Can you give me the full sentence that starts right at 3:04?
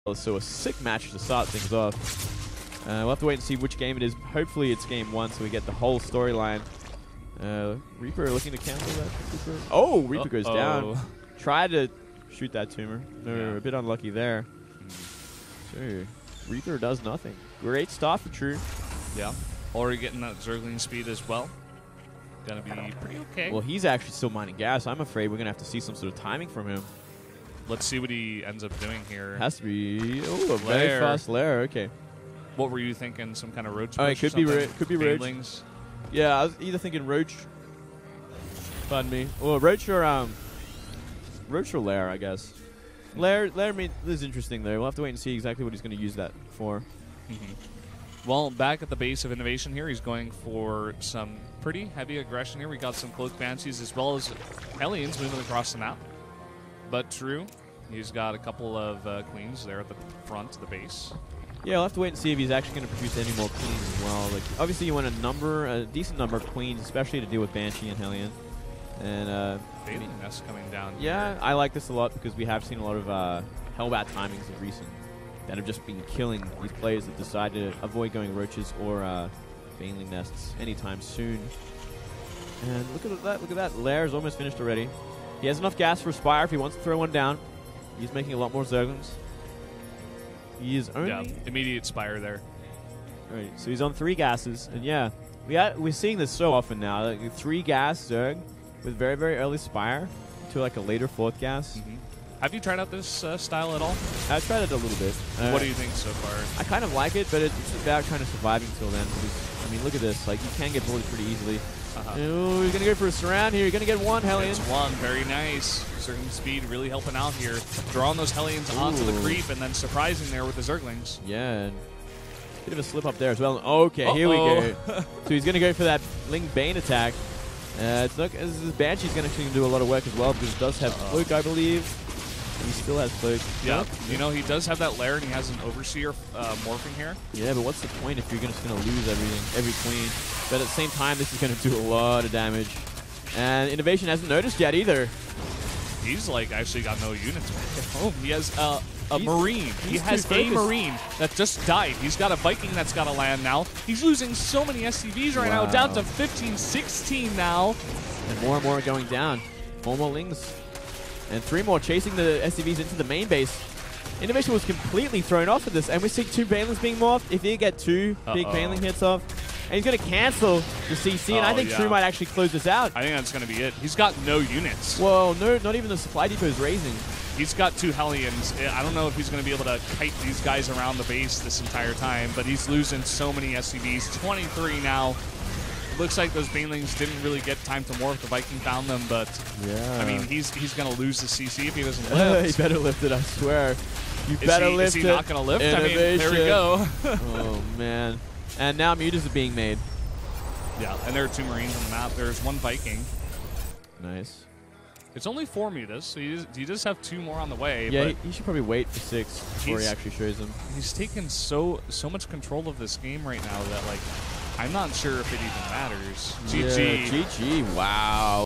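23 now looks like those Banelings didn't really get time to morph.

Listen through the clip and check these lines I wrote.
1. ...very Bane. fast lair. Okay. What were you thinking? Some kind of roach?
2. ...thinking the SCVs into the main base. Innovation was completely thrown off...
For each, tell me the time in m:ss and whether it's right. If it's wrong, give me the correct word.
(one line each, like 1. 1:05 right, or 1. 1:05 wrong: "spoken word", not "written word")
1. 0:30 wrong: "Lair", not "Bane"
2. 2:41 wrong: "chasing", not "thinking".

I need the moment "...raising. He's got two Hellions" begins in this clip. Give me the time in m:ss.
2:56.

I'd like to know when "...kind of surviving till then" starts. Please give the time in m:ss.
1:48.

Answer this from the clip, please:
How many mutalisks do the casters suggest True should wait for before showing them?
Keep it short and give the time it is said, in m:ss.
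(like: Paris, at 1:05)
6, at 3:28.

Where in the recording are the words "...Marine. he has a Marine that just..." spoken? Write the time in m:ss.
2:29.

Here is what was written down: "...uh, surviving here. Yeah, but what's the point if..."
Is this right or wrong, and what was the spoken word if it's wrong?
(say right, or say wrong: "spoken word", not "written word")
wrong: "morphing", not "surviving".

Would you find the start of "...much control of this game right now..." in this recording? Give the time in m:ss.
3:32.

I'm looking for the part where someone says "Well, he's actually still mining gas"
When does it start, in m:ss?
0:23.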